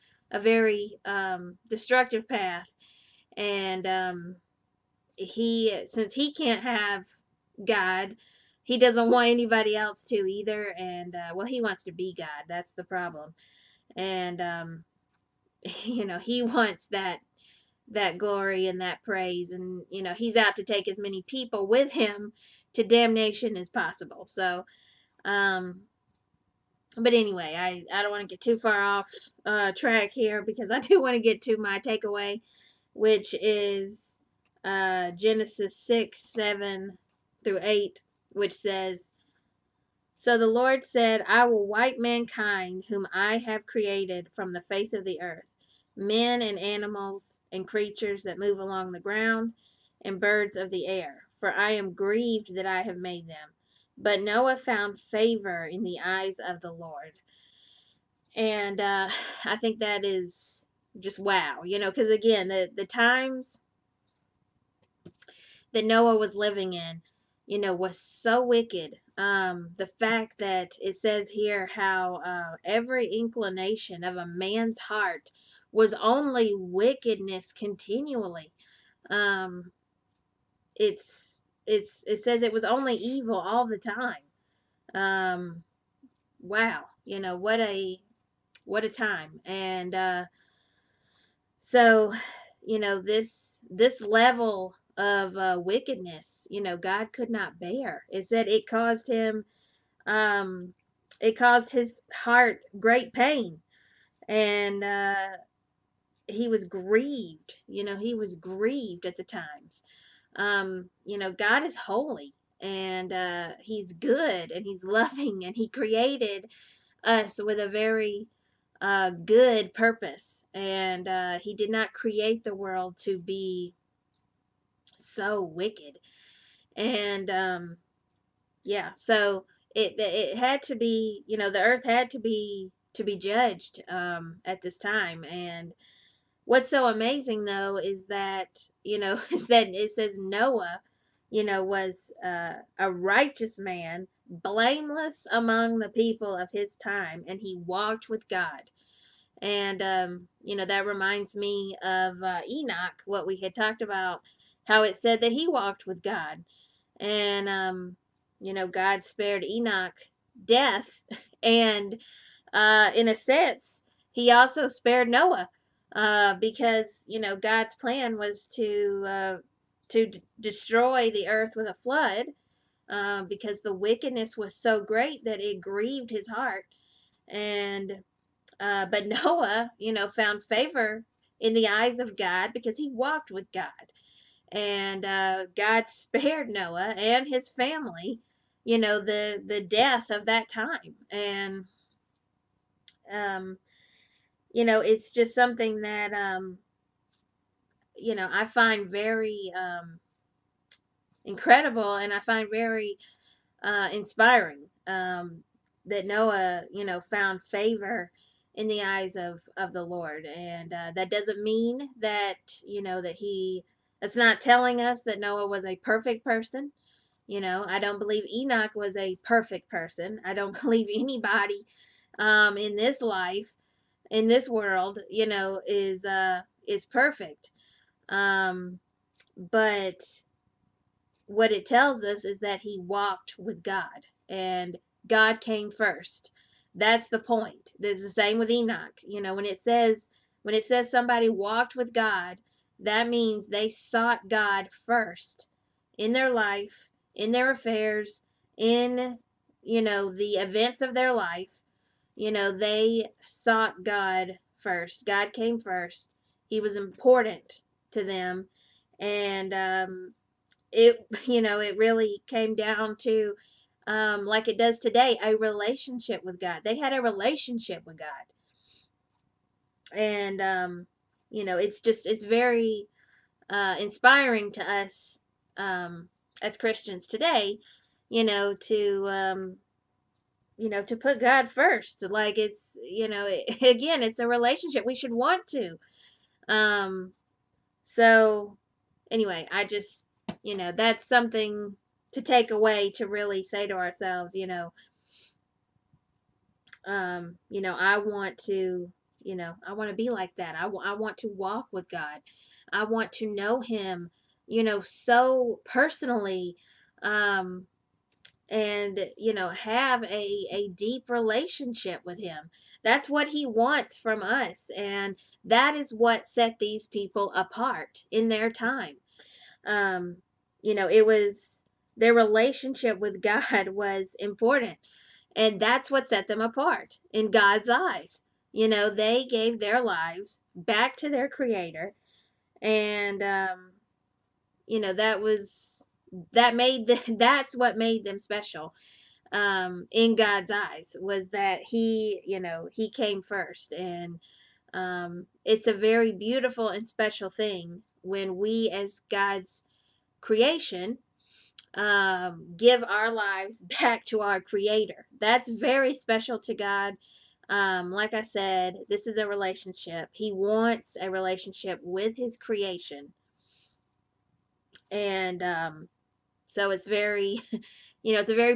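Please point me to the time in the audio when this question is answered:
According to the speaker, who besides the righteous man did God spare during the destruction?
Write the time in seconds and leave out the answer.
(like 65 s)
187 s.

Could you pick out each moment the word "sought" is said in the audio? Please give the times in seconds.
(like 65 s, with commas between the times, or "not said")
243 s, 253 s.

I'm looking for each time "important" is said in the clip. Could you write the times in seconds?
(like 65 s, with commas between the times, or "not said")
256 s, 324 s.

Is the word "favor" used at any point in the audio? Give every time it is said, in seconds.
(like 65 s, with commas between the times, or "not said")
55 s, 180 s, 207 s.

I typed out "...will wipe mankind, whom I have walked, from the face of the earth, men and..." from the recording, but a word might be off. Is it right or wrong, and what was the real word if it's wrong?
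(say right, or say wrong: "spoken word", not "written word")
wrong: "created", not "walked".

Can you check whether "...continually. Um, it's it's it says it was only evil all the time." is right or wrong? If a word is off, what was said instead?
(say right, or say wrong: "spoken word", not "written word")
right.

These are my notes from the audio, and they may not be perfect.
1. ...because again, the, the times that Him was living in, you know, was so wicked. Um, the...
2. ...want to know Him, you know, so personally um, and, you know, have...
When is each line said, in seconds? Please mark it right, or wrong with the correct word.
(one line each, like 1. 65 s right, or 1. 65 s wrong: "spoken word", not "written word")
1. 61 s wrong: "Noah", not "Him"
2. 302 s right.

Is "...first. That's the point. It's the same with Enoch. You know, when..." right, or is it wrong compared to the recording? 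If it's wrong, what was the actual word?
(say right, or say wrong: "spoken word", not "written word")
right.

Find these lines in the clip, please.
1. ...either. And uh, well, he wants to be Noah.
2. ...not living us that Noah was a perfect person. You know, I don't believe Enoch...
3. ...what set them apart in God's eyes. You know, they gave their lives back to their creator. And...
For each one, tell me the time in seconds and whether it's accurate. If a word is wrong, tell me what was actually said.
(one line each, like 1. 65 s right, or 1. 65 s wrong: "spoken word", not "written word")
1. 10 s wrong: "God", not "Noah"
2. 214 s wrong: "telling", not "living"
3. 325 s right.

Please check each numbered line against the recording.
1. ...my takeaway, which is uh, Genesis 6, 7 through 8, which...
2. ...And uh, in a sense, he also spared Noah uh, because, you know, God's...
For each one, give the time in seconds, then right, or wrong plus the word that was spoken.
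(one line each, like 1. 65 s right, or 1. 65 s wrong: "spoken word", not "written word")
1. 31 s right
2. 161 s right.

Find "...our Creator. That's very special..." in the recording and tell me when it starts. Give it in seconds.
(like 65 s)
354 s.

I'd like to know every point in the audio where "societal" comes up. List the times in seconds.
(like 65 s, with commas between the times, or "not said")
not said.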